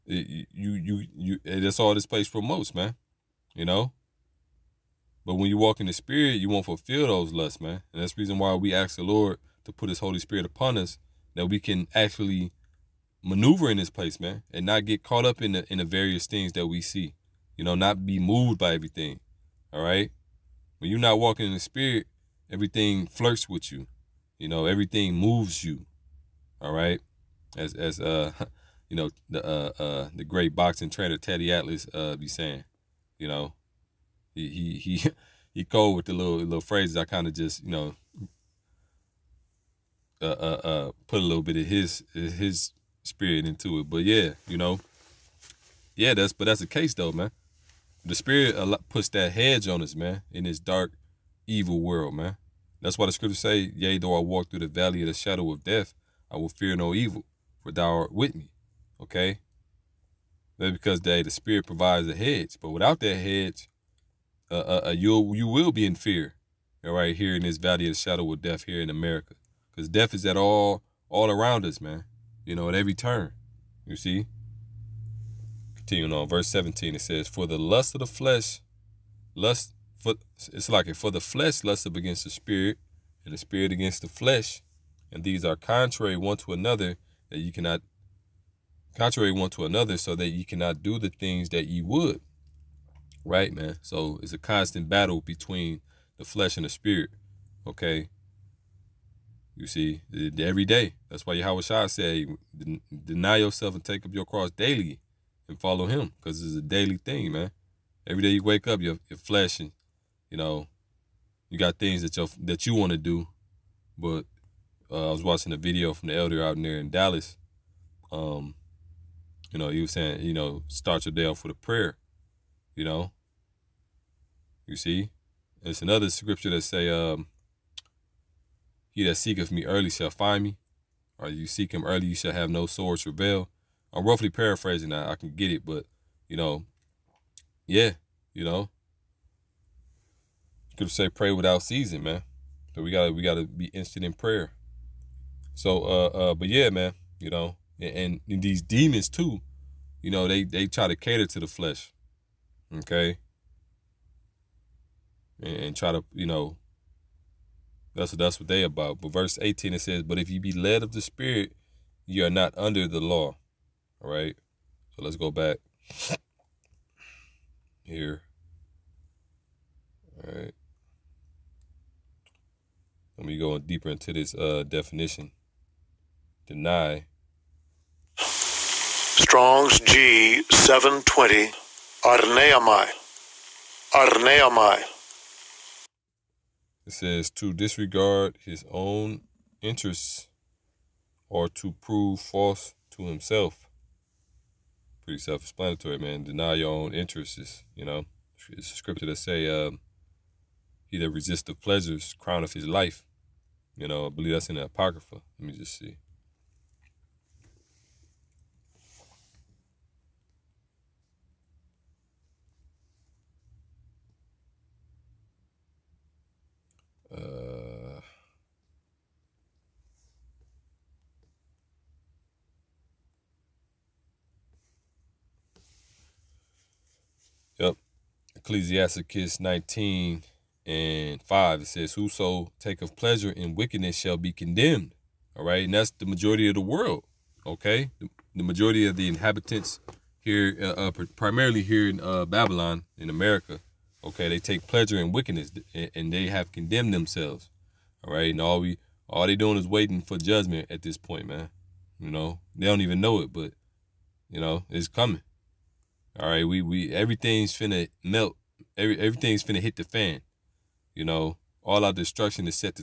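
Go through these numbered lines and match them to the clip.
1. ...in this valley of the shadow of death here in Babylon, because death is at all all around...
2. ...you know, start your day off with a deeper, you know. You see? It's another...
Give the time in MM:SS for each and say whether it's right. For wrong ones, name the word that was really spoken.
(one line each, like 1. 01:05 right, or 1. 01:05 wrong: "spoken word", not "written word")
1. 01:07 wrong: "America", not "Babylon"
2. 02:00 wrong: "prayer", not "deeper".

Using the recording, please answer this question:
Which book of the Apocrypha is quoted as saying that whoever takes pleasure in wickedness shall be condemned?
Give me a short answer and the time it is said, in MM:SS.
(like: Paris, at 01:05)
Ecclesiasticus, at 03:48.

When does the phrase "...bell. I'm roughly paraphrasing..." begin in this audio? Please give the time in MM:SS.
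02:13.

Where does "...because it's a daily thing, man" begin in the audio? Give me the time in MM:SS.
01:46.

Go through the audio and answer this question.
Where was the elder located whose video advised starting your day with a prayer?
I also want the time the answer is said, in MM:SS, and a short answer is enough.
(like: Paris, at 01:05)
Dallas, at 01:56.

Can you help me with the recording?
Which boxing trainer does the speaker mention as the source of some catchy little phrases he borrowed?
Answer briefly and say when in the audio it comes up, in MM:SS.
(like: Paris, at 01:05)
Teddy Atlas, at 00:31.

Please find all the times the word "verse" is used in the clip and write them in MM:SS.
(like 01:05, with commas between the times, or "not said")
01:16, 02:39.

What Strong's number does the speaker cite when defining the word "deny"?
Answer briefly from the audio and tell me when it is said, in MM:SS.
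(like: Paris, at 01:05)
G720, at 02:59.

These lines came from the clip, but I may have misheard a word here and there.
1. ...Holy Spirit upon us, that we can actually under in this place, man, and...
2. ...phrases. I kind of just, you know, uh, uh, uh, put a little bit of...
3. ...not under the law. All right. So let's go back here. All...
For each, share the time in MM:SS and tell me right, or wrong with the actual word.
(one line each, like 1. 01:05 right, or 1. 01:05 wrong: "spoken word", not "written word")
1. 00:10 wrong: "maneuver", not "under"
2. 00:36 right
3. 02:42 right.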